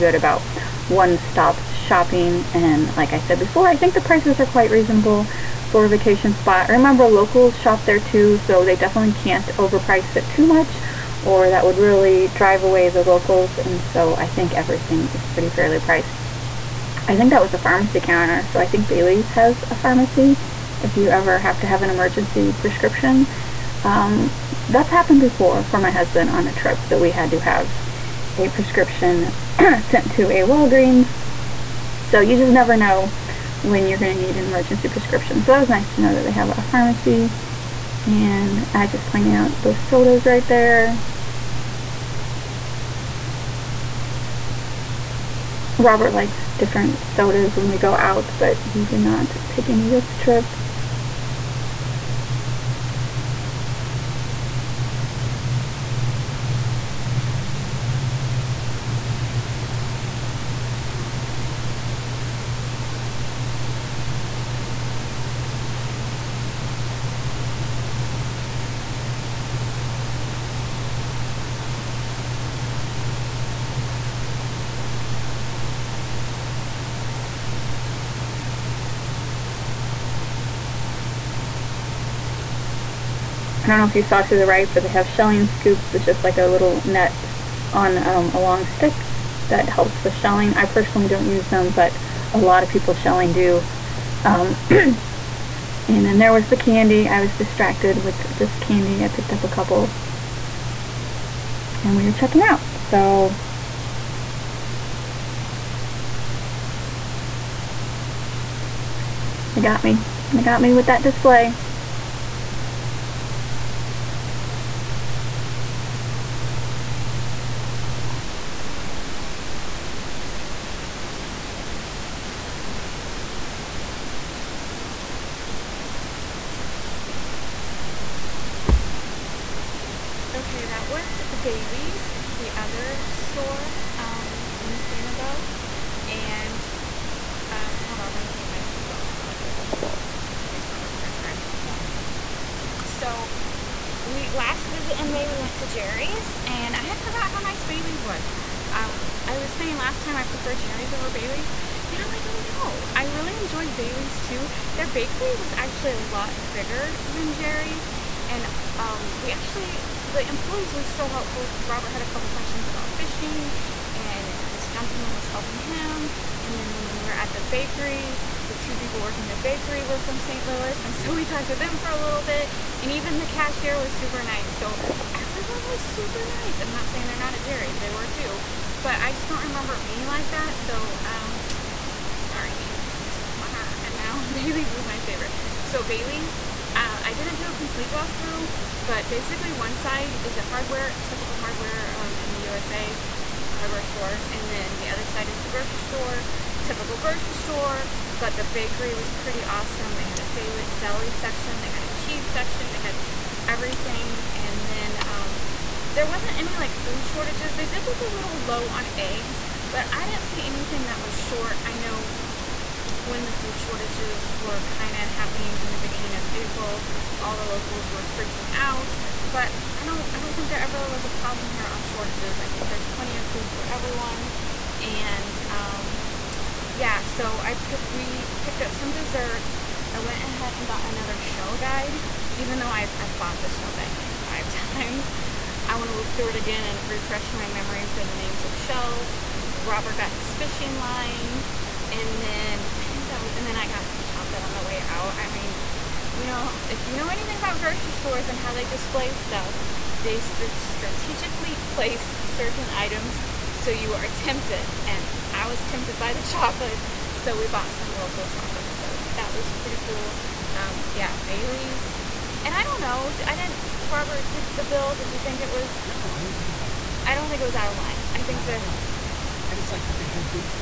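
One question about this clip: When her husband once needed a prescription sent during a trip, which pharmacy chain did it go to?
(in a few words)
Walgreens.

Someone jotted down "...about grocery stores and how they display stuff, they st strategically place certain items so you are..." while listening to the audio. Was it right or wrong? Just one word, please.
right.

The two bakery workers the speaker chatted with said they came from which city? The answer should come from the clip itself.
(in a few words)
St. Louis.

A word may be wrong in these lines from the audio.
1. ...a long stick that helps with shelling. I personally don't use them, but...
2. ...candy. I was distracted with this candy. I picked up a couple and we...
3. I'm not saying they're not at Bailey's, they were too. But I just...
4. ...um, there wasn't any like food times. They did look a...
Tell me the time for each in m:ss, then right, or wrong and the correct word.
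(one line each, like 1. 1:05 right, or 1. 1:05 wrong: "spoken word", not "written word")
1. 1:28 right
2. 1:36 right
3. 2:56 wrong: "Jerry", not "Bailey"
4. 3:25 wrong: "shortages", not "times".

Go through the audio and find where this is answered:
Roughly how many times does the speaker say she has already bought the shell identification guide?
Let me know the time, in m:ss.
3:54.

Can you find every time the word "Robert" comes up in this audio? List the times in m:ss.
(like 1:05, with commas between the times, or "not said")
0:45, 2:20, 2:41, 3:59, 4:23.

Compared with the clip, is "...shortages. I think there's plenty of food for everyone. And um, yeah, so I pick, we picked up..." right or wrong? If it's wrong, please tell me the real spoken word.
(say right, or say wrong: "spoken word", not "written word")
right.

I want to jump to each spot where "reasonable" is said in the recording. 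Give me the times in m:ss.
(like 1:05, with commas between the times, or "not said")
0:04.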